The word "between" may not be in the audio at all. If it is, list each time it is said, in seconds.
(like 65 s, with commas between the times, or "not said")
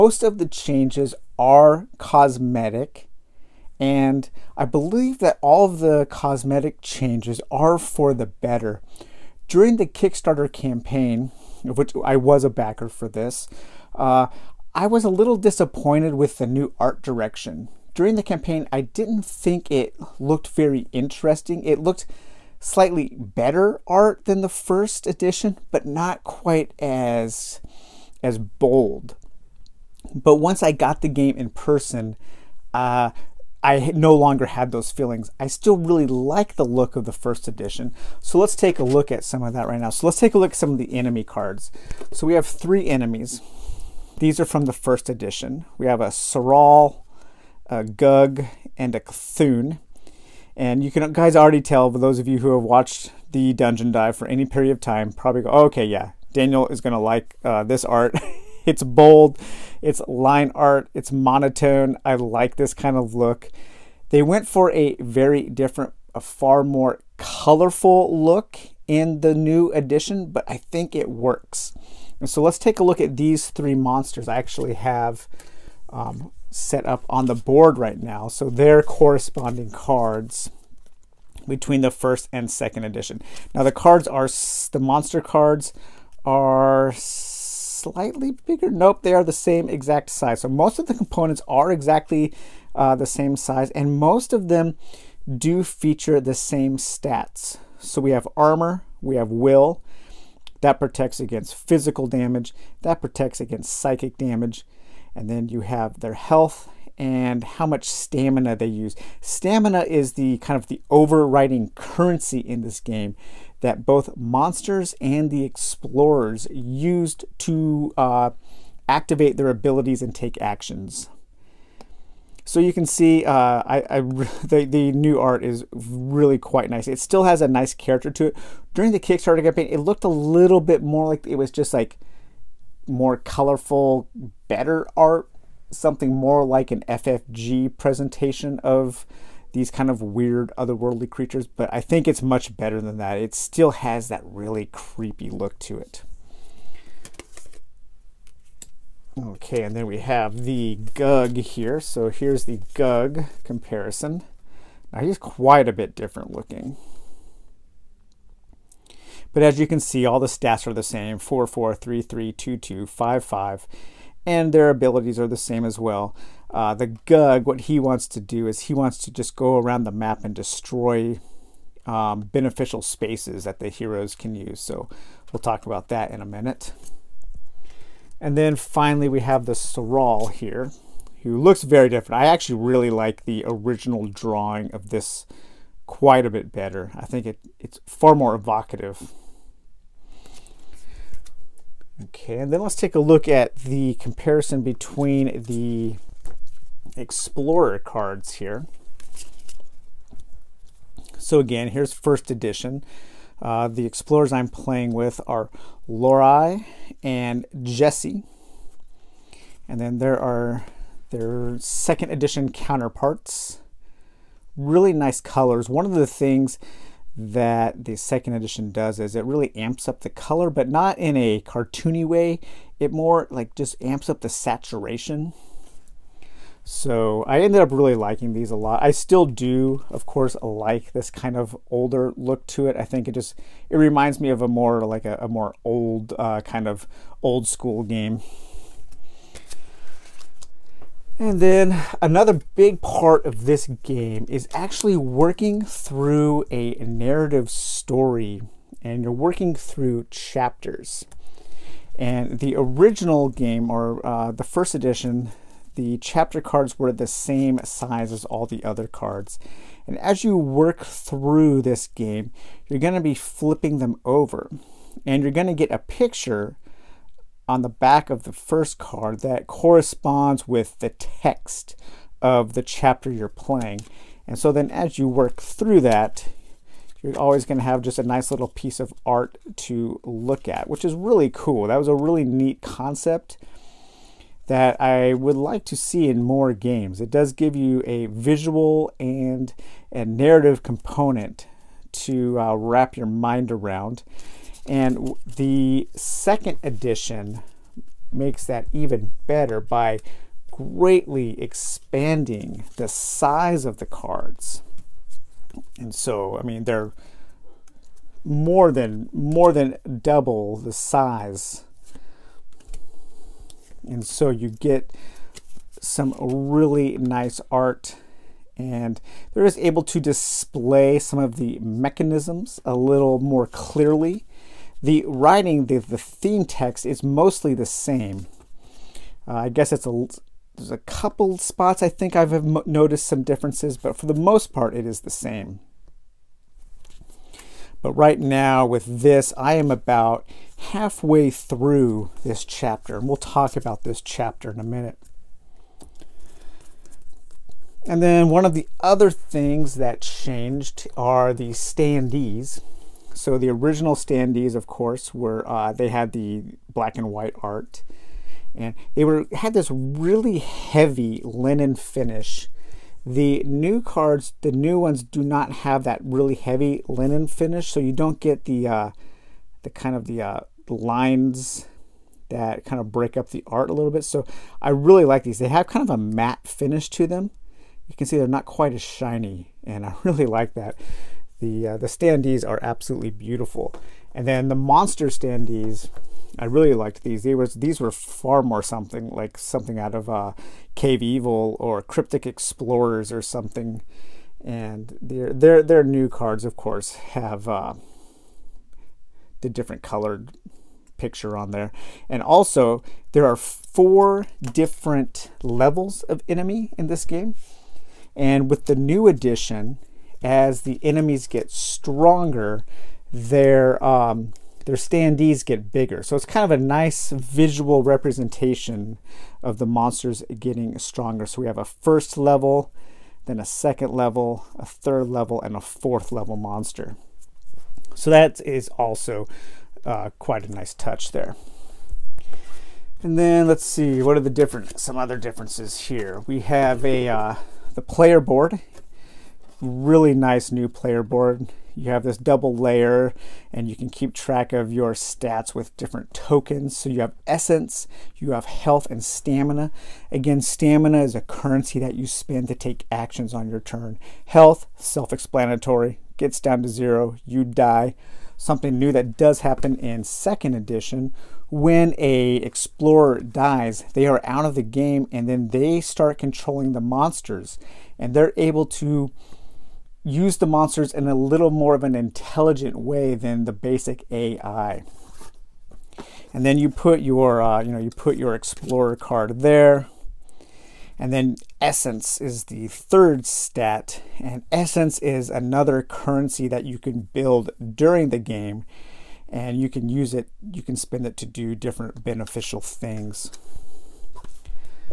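81 s, 194 s.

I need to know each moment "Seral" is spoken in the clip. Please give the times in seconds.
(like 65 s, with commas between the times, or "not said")
179 s.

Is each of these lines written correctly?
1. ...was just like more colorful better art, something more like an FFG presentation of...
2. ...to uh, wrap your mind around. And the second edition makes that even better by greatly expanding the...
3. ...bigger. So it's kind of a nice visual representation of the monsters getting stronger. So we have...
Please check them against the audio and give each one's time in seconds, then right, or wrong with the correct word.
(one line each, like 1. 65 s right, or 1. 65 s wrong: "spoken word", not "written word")
1. 131 s right
2. 291 s right
3. 415 s right.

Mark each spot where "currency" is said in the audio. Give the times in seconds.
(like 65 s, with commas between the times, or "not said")
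111 s, 451 s, 485 s.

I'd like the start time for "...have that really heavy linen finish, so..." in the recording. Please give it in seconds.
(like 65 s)
365 s.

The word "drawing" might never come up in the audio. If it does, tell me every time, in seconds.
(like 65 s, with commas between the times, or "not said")
184 s.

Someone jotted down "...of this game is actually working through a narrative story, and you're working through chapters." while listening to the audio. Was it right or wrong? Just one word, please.
right.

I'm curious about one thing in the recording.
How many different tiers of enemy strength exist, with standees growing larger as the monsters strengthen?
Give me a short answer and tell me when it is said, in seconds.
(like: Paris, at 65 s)
4, at 403 s.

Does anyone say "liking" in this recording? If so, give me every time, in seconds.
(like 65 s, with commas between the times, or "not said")
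227 s.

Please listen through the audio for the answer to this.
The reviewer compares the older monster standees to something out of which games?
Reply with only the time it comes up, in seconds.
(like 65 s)
390 s.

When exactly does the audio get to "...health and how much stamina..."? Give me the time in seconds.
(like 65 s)
106 s.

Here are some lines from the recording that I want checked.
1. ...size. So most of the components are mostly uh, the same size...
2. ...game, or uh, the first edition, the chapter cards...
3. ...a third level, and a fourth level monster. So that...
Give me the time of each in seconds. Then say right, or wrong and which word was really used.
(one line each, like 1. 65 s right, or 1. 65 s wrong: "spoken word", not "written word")
1. 90 s wrong: "exactly", not "mostly"
2. 253 s right
3. 424 s right.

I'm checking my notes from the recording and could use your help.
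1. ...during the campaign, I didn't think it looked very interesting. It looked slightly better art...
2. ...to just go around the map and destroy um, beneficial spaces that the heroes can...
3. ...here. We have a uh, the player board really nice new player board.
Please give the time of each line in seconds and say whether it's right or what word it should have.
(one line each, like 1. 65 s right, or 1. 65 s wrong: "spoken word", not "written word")
1. 17 s right
2. 169 s right
3. 435 s right.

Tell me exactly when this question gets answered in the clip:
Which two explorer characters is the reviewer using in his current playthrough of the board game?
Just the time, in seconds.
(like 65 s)
205 s.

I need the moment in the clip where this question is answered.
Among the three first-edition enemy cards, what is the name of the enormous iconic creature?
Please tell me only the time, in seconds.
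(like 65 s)
48 s.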